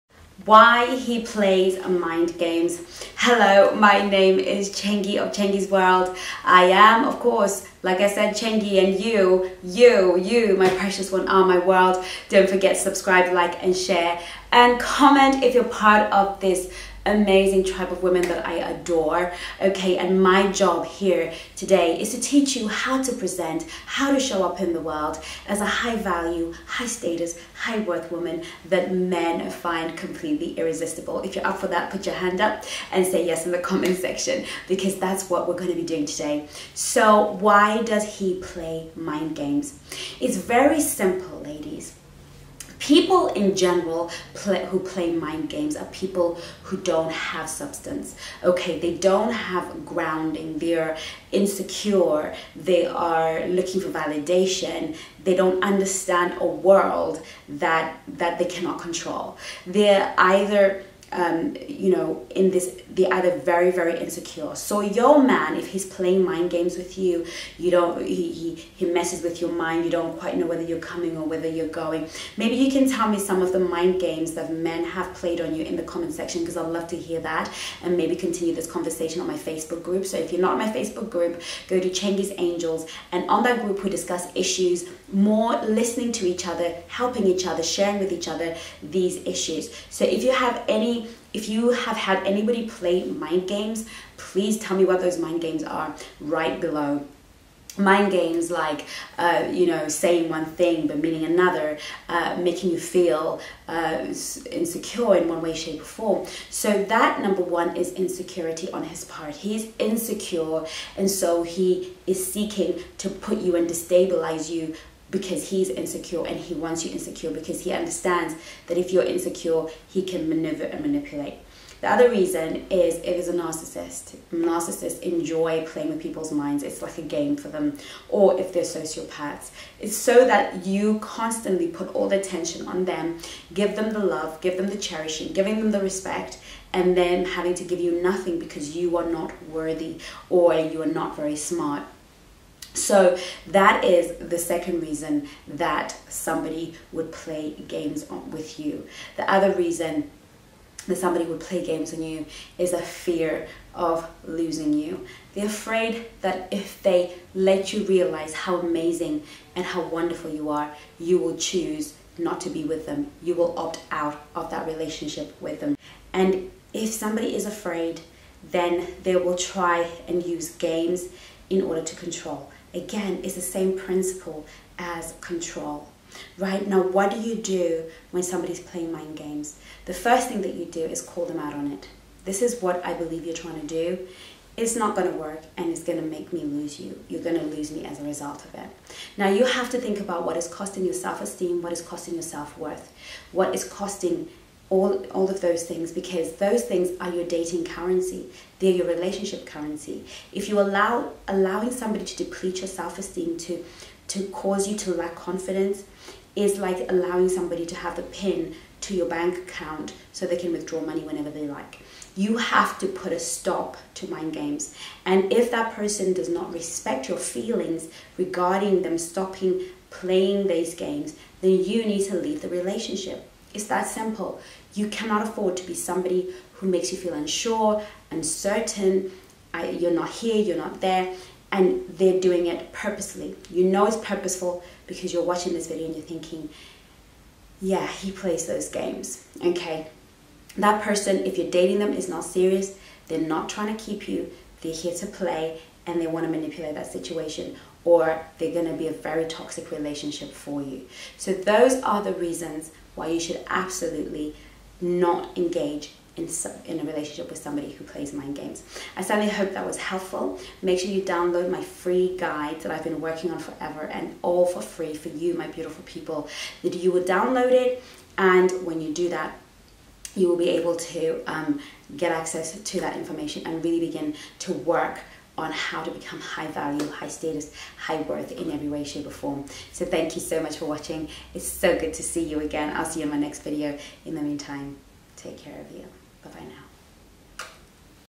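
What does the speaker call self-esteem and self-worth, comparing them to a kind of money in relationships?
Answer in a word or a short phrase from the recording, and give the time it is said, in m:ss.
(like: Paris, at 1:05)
Dating currency, at 3:17.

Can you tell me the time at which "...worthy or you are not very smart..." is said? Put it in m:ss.
2:19.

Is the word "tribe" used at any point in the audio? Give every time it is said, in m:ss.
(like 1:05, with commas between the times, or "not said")
0:17.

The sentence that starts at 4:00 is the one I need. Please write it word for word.
That person, if you're dating them, is not serious.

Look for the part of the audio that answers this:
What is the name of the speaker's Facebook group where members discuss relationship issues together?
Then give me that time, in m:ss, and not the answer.
1:21.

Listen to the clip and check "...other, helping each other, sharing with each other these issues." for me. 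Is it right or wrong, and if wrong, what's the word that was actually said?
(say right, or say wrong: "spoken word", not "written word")
right.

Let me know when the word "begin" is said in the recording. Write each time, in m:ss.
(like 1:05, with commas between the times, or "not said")
4:33.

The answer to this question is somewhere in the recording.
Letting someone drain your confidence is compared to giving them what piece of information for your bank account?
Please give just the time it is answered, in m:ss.
3:28.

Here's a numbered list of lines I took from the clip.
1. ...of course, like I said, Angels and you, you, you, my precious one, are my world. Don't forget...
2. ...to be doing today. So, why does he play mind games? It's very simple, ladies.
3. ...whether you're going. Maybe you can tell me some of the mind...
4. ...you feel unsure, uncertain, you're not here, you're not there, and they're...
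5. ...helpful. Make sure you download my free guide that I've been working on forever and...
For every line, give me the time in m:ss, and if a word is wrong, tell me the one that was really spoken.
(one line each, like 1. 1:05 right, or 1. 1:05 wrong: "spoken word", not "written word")
1. 0:07 wrong: "Chengi", not "Angels"
2. 0:35 right
3. 1:11 right
4. 3:46 right
5. 4:19 right.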